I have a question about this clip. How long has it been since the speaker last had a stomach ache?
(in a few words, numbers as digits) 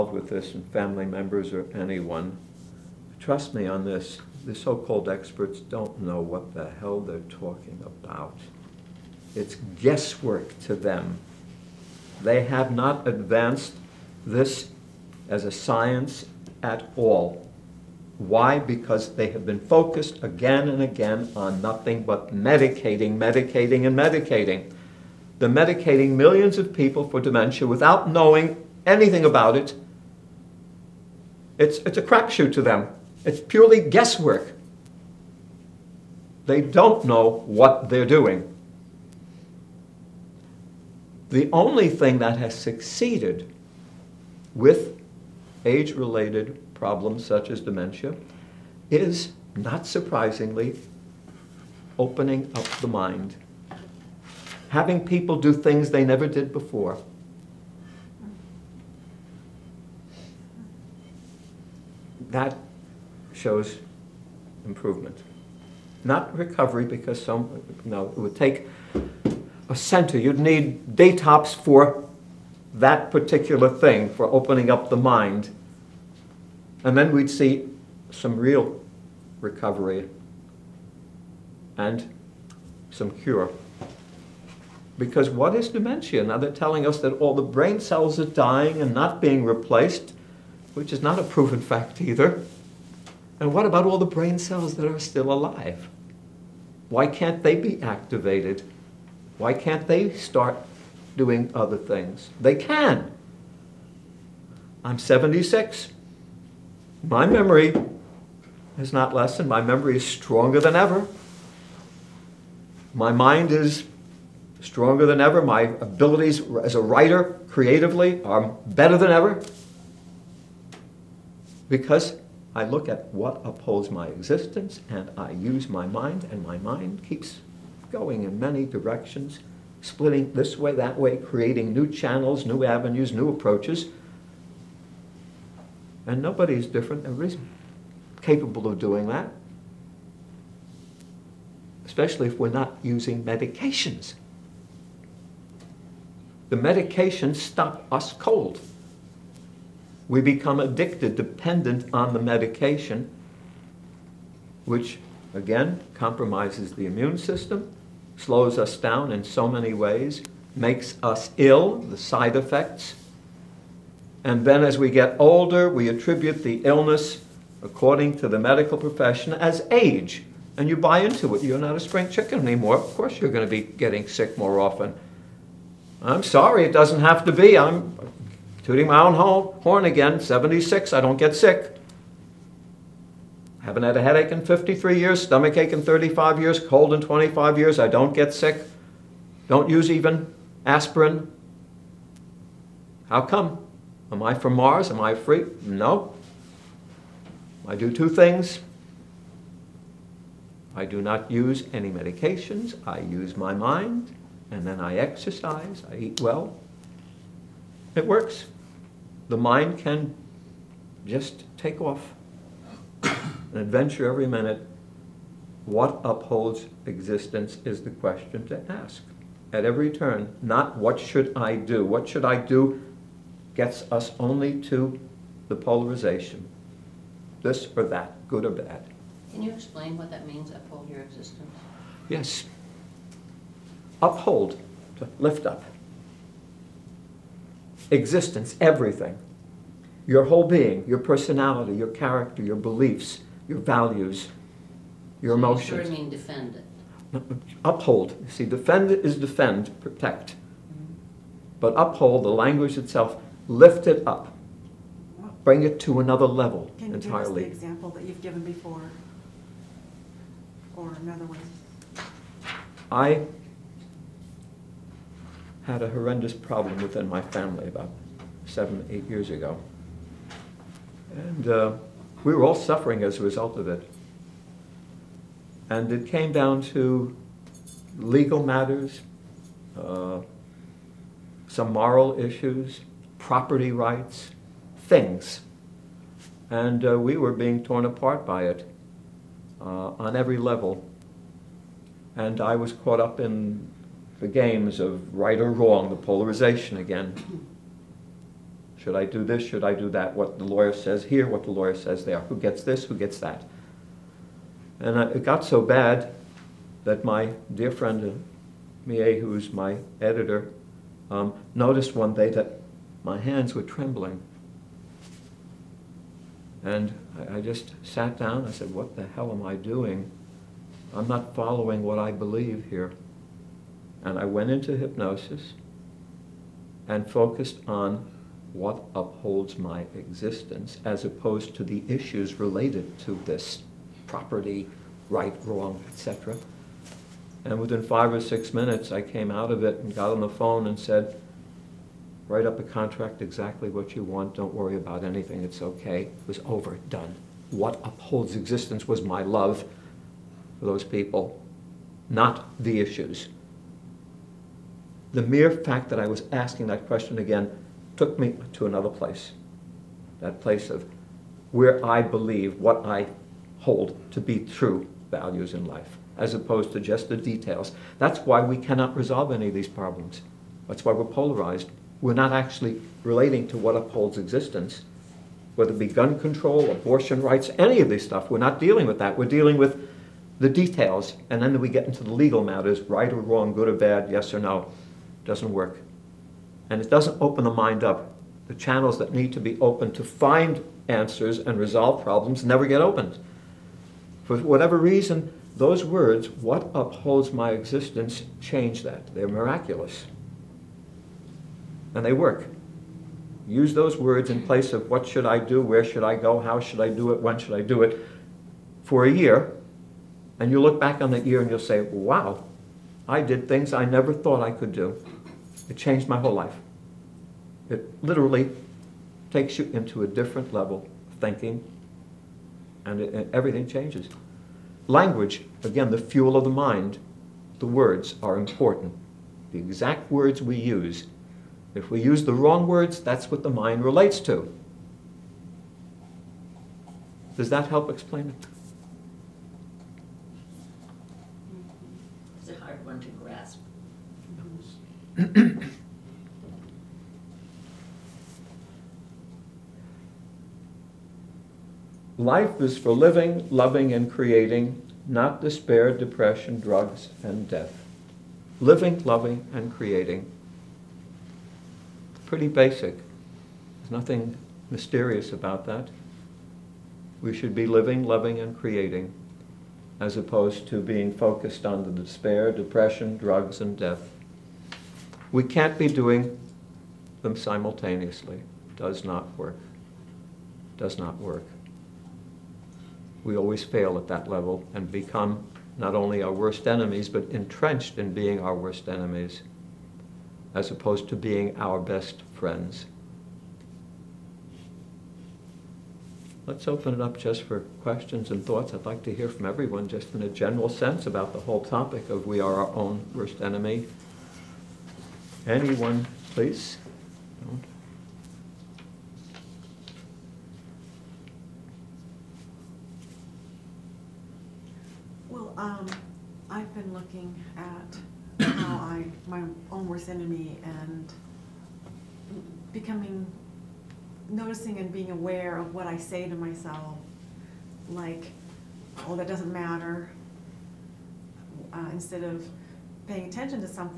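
35 years.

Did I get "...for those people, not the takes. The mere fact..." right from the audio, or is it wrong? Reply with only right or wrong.
wrong.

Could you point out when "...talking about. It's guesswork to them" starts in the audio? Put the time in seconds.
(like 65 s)
7 s.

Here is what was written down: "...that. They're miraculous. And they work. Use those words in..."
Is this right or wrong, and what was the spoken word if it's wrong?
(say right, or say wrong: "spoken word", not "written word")
right.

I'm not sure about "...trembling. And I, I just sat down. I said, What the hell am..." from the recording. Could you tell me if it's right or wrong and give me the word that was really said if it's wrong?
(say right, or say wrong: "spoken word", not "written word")
right.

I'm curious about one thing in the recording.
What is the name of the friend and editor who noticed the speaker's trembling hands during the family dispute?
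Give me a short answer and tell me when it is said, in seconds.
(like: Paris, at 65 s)
Mie, at 308 s.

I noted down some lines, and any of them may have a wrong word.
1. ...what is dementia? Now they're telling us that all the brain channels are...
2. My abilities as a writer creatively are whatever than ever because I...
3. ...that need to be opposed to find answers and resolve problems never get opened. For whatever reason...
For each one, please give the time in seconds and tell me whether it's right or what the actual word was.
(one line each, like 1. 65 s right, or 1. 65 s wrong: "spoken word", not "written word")
1. 85 s wrong: "cells", not "channels"
2. 115 s wrong: "better", not "whatever"
3. 388 s wrong: "opened", not "opposed".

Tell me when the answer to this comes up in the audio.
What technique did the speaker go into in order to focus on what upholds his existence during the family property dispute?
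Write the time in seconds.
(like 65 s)
324 s.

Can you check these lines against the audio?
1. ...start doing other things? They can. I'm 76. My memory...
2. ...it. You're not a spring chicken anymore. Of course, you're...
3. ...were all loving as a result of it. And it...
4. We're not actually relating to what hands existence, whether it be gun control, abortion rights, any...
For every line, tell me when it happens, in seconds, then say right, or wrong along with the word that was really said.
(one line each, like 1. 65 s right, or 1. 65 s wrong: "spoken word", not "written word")
1. 100 s right
2. 171 s right
3. 272 s wrong: "suffering", not "loving"
4. 372 s wrong: "upholds", not "hands".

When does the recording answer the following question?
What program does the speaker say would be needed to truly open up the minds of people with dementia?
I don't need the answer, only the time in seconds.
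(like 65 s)
70 s.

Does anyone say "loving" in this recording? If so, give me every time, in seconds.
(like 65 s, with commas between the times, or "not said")
453 s, 459 s, 468 s.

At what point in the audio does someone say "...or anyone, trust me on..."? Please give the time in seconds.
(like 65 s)
1 s.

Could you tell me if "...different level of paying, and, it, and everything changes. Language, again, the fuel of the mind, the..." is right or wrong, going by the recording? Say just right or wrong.
wrong.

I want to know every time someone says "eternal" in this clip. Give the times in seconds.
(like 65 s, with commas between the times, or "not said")
not said.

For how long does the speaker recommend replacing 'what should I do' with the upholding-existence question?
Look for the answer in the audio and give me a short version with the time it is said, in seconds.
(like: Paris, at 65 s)
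a year, at 409 s.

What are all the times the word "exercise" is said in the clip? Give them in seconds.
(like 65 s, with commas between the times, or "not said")
204 s.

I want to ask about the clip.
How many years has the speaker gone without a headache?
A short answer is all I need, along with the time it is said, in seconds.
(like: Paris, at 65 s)
53, at 184 s.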